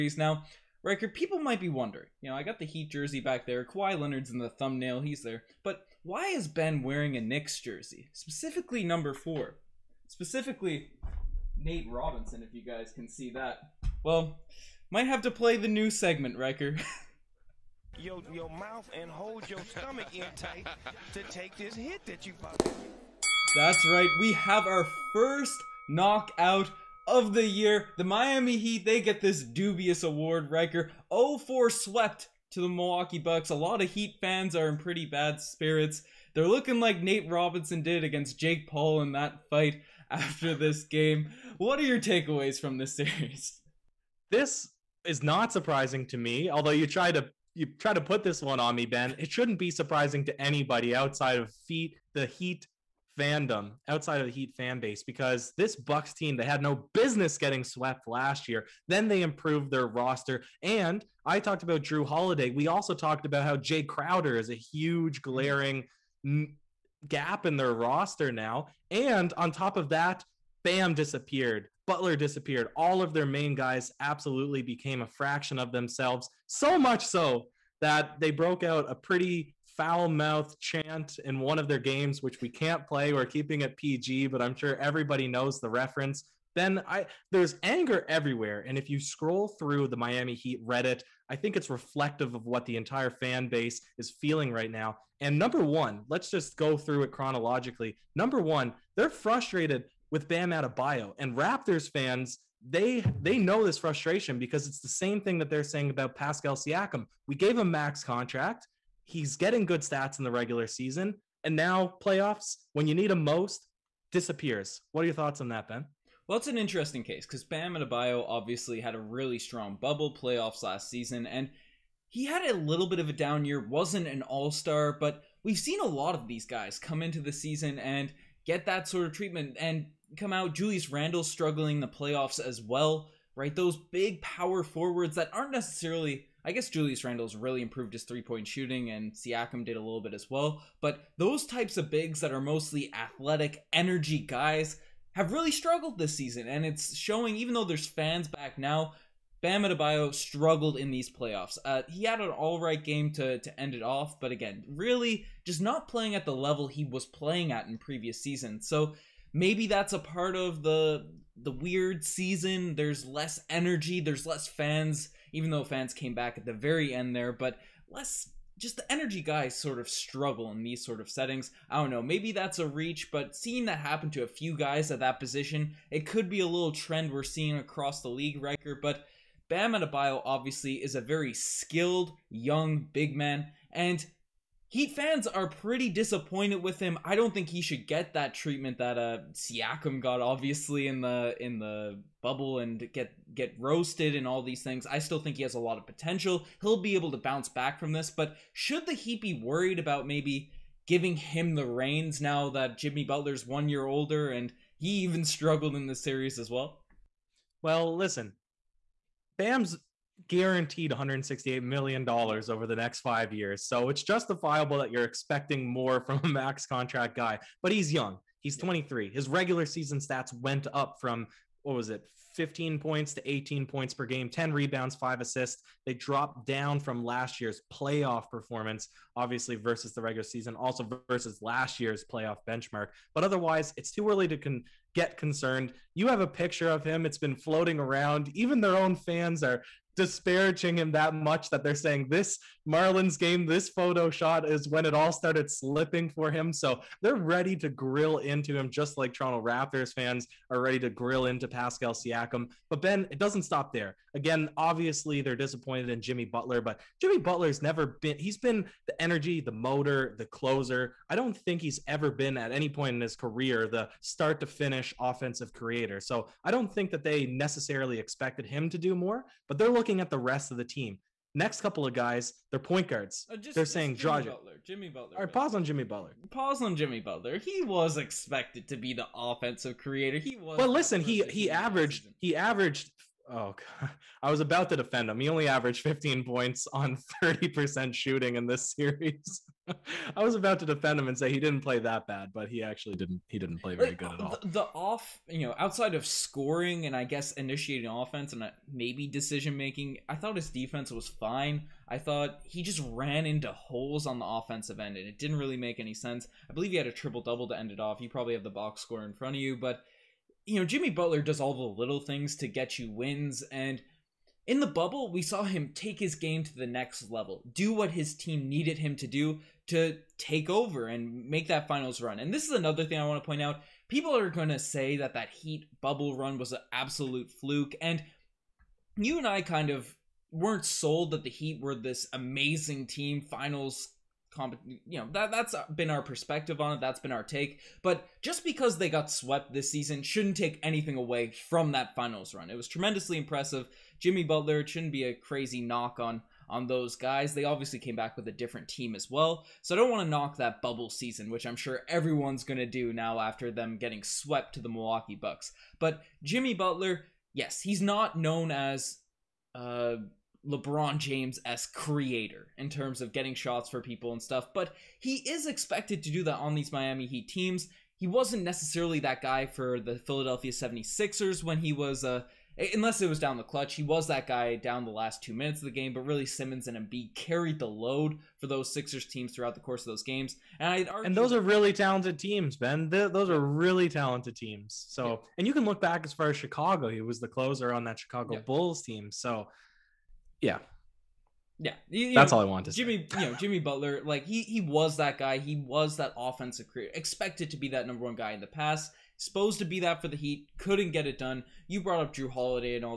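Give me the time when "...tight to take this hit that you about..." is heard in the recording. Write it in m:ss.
0:20.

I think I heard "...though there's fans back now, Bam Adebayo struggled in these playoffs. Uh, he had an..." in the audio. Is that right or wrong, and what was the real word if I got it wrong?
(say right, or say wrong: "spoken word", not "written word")
right.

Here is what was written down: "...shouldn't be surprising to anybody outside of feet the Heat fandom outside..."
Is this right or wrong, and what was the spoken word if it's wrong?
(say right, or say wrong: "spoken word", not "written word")
right.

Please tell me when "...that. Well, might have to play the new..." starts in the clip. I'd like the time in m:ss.
0:13.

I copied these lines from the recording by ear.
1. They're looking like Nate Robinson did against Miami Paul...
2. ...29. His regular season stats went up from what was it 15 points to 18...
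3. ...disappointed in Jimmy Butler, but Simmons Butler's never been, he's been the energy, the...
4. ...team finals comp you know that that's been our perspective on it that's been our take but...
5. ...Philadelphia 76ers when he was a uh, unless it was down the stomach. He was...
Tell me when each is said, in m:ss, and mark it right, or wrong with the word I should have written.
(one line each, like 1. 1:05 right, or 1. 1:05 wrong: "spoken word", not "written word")
1. 0:36 wrong: "Jake", not "Miami"
2. 3:38 wrong: "23", not "29"
3. 4:15 wrong: "Jimmy", not "Simmons"
4. 5:32 right
5. 6:09 wrong: "clutch", not "stomach".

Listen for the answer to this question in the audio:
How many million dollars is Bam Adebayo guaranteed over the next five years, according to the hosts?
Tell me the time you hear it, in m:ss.
3:30.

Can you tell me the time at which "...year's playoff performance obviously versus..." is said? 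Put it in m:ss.
3:47.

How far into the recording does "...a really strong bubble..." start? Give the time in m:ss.
1:58.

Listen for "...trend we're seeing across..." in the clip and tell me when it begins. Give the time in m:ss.
2:56.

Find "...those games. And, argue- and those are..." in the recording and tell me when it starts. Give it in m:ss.
6:19.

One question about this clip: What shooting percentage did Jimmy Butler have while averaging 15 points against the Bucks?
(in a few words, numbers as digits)
30%.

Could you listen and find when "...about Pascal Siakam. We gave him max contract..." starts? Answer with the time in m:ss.
1:45.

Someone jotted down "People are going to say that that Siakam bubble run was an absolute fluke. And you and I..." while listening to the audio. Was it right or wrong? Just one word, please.
wrong.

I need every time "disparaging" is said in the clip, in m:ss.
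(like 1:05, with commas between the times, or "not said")
3:59.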